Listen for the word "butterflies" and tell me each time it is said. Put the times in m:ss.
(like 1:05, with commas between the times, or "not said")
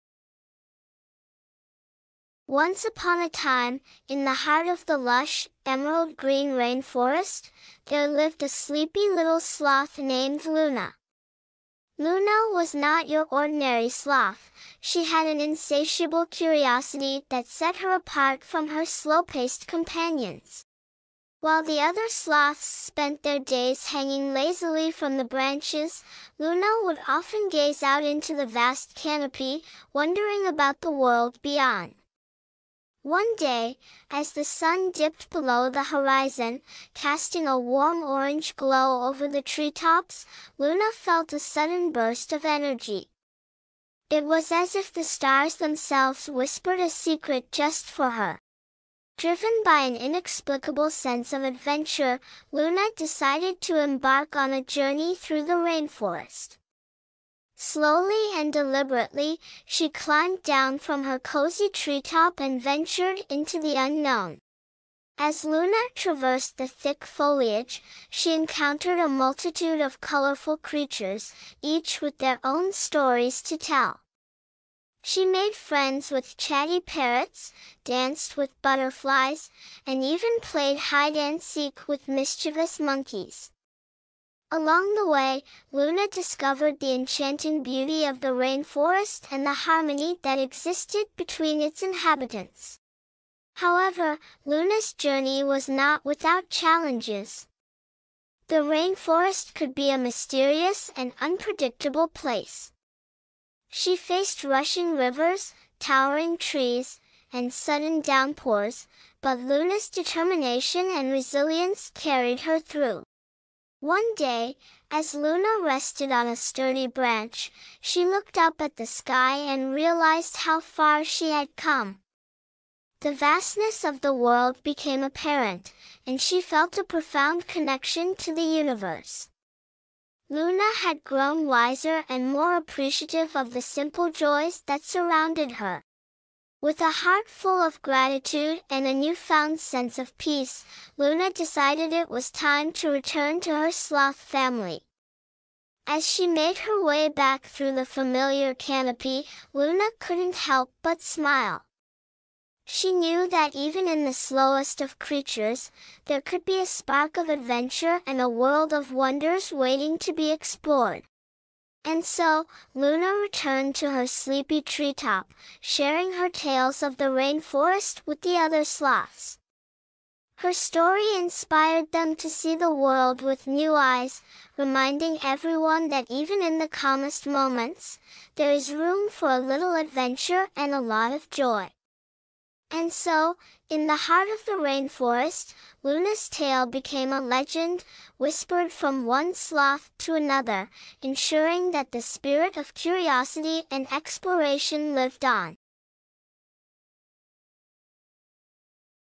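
1:18.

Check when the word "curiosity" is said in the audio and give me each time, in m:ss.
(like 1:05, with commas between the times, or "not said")
0:16, 3:12.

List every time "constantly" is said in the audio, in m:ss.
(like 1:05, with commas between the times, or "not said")
not said.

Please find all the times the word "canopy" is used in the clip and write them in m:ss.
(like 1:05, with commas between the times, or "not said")
0:28, 2:28.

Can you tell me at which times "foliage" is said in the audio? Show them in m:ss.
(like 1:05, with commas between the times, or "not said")
1:07.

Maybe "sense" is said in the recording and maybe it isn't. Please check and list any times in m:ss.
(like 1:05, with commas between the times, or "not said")
0:50, 2:19.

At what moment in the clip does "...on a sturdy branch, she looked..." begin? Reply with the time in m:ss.
1:56.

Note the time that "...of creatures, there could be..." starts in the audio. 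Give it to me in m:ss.
2:34.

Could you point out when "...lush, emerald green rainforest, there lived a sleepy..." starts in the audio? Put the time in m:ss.
0:04.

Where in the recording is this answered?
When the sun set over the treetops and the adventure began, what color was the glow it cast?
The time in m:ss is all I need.
0:37.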